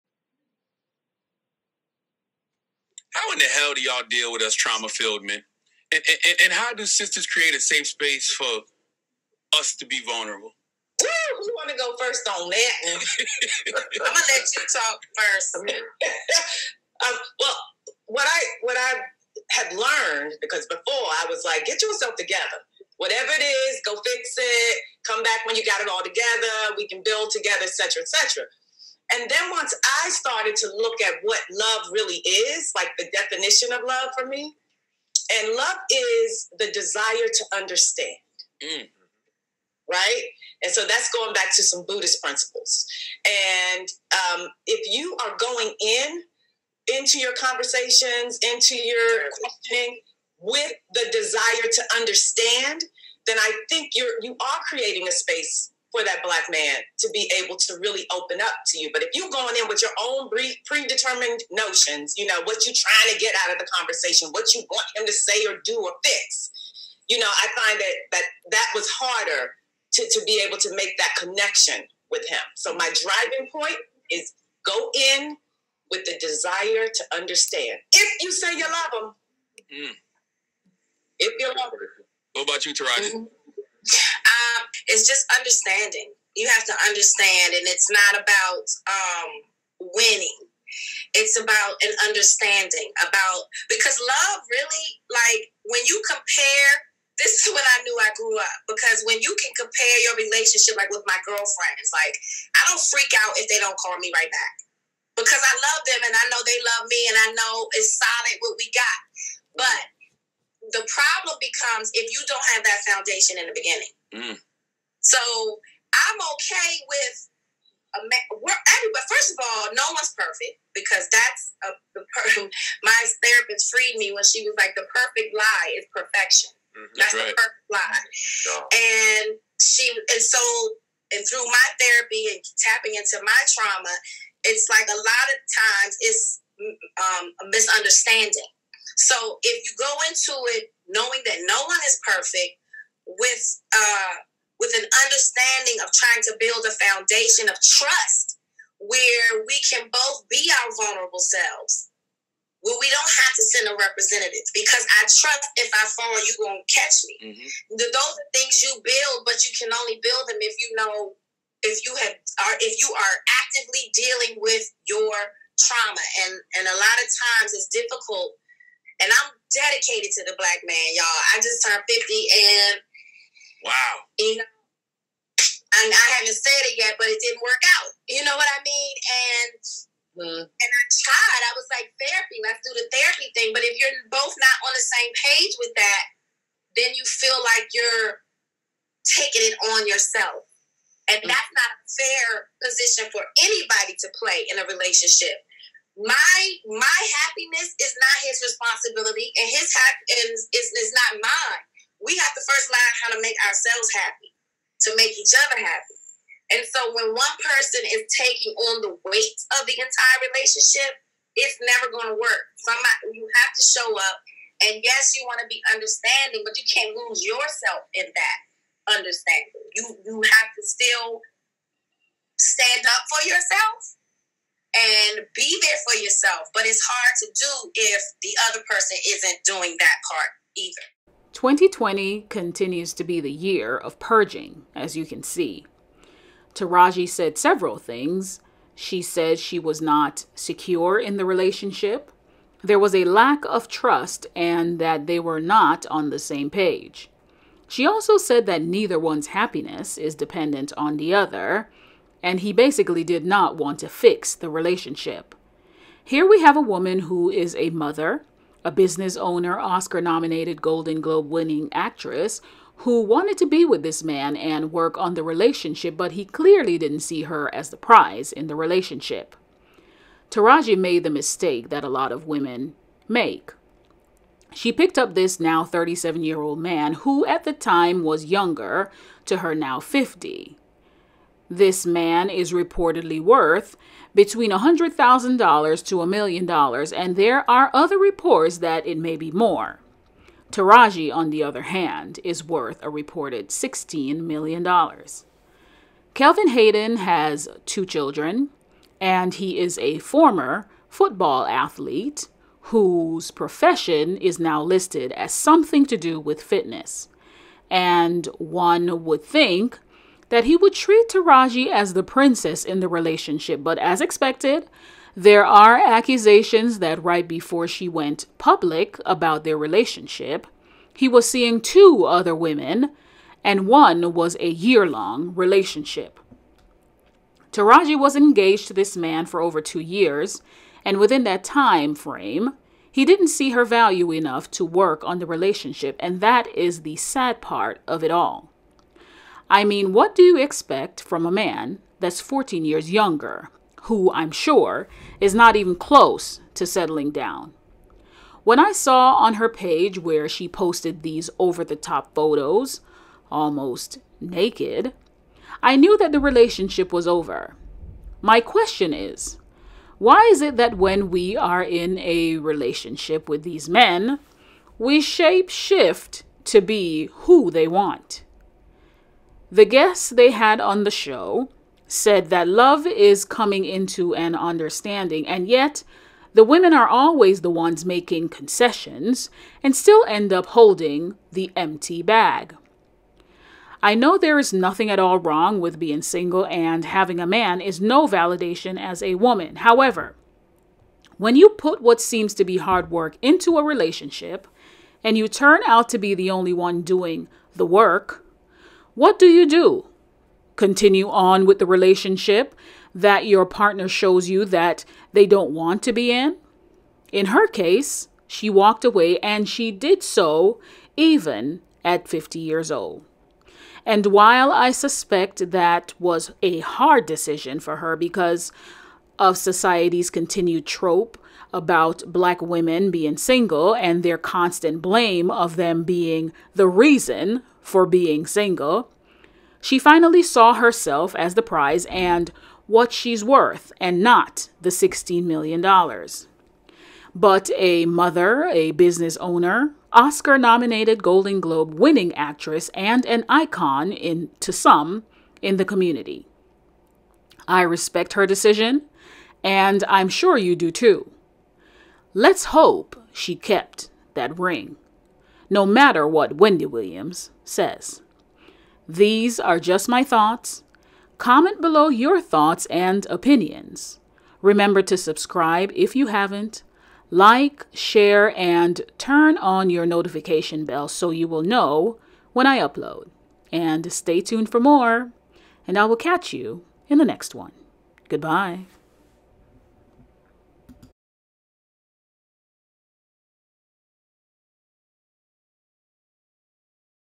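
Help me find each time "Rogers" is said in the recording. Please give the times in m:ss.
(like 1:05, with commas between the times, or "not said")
not said.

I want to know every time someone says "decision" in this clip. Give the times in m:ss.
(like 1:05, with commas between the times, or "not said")
6:57, 7:28.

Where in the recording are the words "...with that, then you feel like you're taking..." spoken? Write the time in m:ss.
3:05.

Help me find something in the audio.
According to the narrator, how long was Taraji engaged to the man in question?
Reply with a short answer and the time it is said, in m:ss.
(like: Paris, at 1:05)
Over two years, at 5:29.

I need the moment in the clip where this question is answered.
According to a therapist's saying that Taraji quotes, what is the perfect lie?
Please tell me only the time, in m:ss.
2:05.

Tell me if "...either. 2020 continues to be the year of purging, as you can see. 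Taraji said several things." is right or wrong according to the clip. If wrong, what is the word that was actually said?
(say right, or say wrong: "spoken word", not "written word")
right.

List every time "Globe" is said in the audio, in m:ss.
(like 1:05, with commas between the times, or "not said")
4:21, 7:21.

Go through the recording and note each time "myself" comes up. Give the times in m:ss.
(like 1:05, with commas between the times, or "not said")
not said.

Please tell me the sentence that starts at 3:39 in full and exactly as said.
You you have to still stand up for yourself and be there for yourself.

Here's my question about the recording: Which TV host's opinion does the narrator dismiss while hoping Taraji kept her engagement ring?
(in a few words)
Wendy Williams.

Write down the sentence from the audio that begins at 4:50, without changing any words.
Taraji, on the other hand, is worth a reported $16 million.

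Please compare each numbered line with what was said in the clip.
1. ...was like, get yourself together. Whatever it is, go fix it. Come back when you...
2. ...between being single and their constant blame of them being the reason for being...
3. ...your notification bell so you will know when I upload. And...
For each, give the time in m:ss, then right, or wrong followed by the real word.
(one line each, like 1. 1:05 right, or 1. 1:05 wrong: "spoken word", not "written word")
1. 0:21 right
2. 7:02 wrong: "women", not "between"
3. 7:49 right.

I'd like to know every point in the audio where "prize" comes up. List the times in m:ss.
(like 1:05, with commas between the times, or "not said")
4:27, 7:11.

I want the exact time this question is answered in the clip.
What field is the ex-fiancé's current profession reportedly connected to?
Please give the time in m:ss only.
5:06.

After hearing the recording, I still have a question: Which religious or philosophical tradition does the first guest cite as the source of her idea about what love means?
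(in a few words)
Buddhist.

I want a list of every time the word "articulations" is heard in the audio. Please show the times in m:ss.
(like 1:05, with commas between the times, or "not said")
not said.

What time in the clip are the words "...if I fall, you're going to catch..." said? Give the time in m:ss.
2:35.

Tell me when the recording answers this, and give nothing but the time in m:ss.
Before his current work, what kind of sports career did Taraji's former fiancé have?
5:00.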